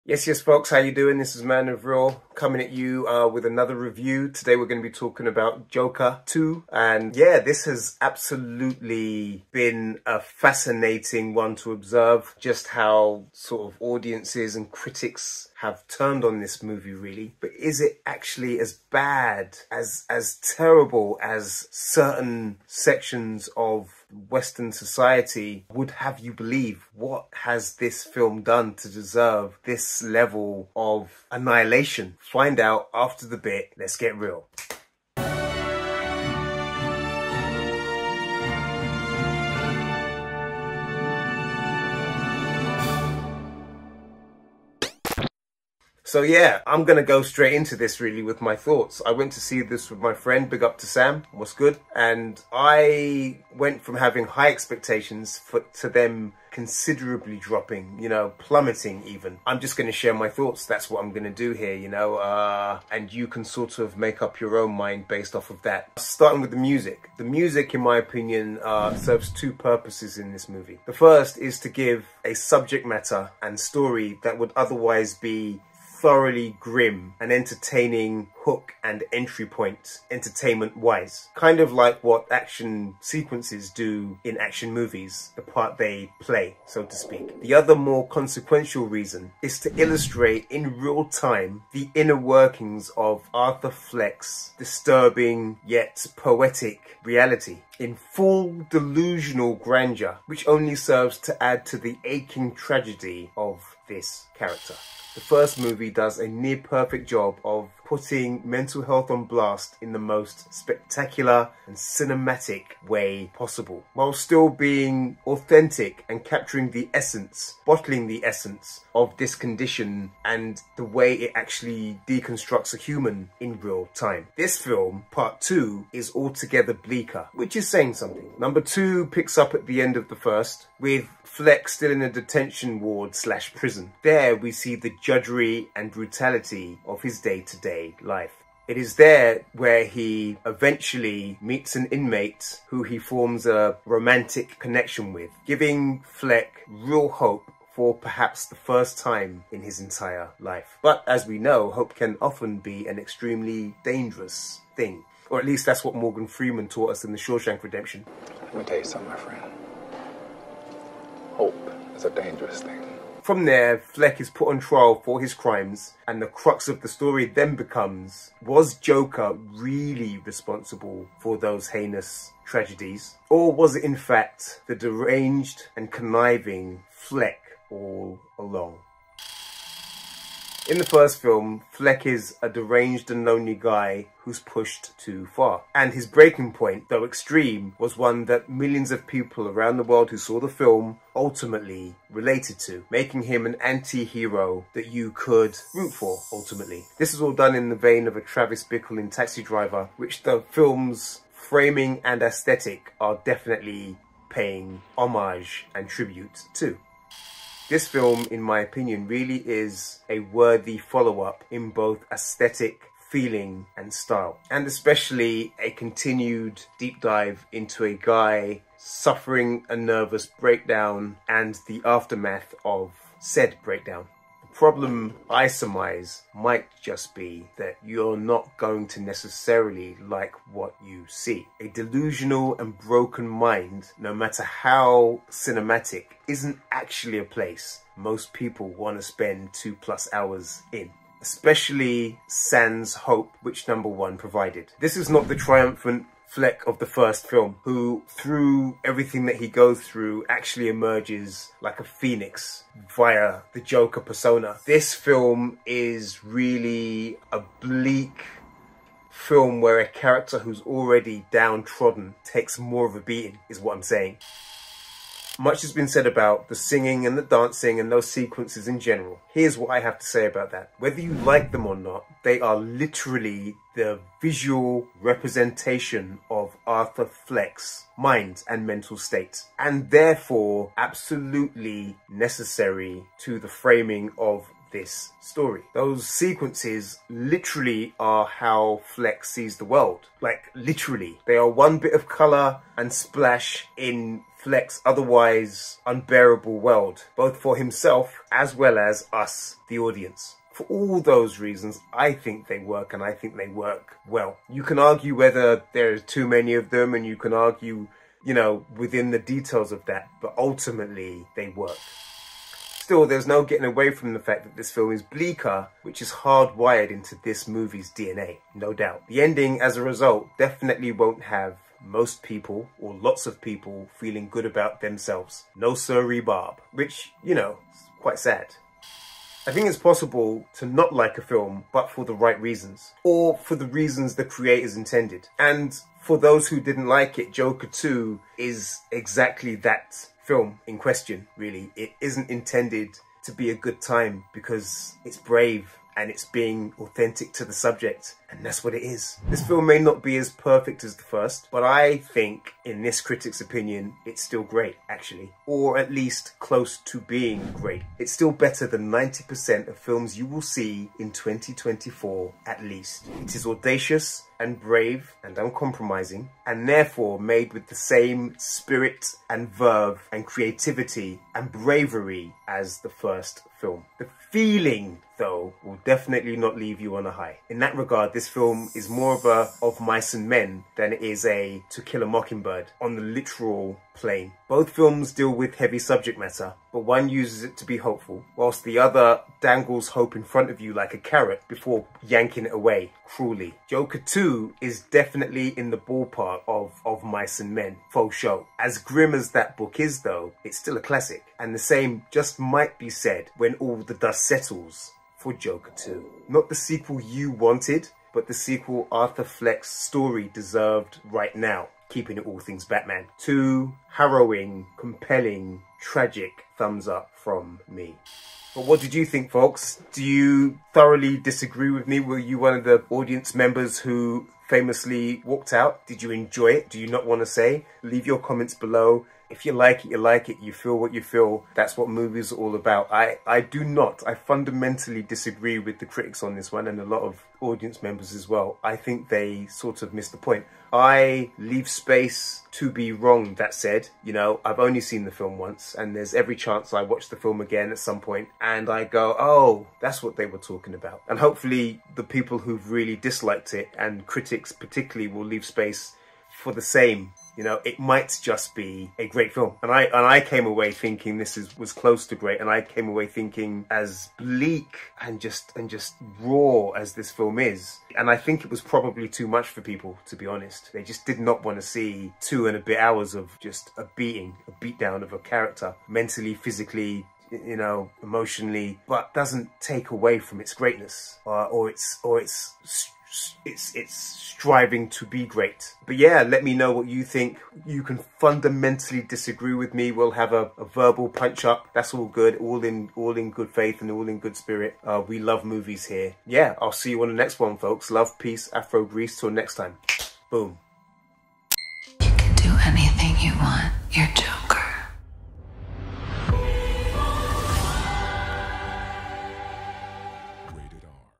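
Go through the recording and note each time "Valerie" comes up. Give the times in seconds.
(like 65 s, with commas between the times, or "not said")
not said.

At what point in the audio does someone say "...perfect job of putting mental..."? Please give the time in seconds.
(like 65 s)
106 s.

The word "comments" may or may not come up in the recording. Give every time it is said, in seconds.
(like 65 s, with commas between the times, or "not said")
428 s.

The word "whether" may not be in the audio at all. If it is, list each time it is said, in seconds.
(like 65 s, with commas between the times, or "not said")
270 s, 305 s.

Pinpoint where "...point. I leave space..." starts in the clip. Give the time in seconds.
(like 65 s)
440 s.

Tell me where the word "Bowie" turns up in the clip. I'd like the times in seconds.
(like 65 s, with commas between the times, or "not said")
not said.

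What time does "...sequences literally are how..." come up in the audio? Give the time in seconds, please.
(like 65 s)
286 s.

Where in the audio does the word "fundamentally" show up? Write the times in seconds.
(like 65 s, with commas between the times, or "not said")
434 s, 488 s.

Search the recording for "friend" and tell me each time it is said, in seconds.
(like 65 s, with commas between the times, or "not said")
50 s, 159 s.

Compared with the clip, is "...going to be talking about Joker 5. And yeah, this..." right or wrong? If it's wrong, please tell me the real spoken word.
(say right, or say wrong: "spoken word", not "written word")
wrong: "2", not "5".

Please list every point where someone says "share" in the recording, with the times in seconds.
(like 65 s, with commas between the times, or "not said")
59 s.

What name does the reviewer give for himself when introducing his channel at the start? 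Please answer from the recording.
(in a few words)
Man of Raw.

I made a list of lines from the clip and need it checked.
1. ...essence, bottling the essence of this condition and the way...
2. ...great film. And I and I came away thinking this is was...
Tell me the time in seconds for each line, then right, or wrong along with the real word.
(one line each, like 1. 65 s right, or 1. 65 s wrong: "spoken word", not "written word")
1. 116 s right
2. 459 s right.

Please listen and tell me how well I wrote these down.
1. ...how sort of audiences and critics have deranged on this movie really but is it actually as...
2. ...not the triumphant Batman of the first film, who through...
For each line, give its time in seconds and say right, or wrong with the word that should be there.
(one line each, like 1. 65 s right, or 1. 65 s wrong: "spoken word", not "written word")
1. 12 s wrong: "turned", not "deranged"
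2. 245 s wrong: "Fleck", not "Batman".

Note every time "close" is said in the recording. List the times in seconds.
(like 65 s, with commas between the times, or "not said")
356 s, 461 s.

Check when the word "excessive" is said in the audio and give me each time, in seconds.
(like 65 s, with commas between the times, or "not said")
not said.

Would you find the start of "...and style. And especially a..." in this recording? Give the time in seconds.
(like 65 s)
213 s.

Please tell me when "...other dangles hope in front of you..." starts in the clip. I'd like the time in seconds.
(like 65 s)
388 s.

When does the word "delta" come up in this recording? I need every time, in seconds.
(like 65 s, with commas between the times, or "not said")
not said.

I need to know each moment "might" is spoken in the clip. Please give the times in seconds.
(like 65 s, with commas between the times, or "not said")
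226 s, 402 s, 457 s.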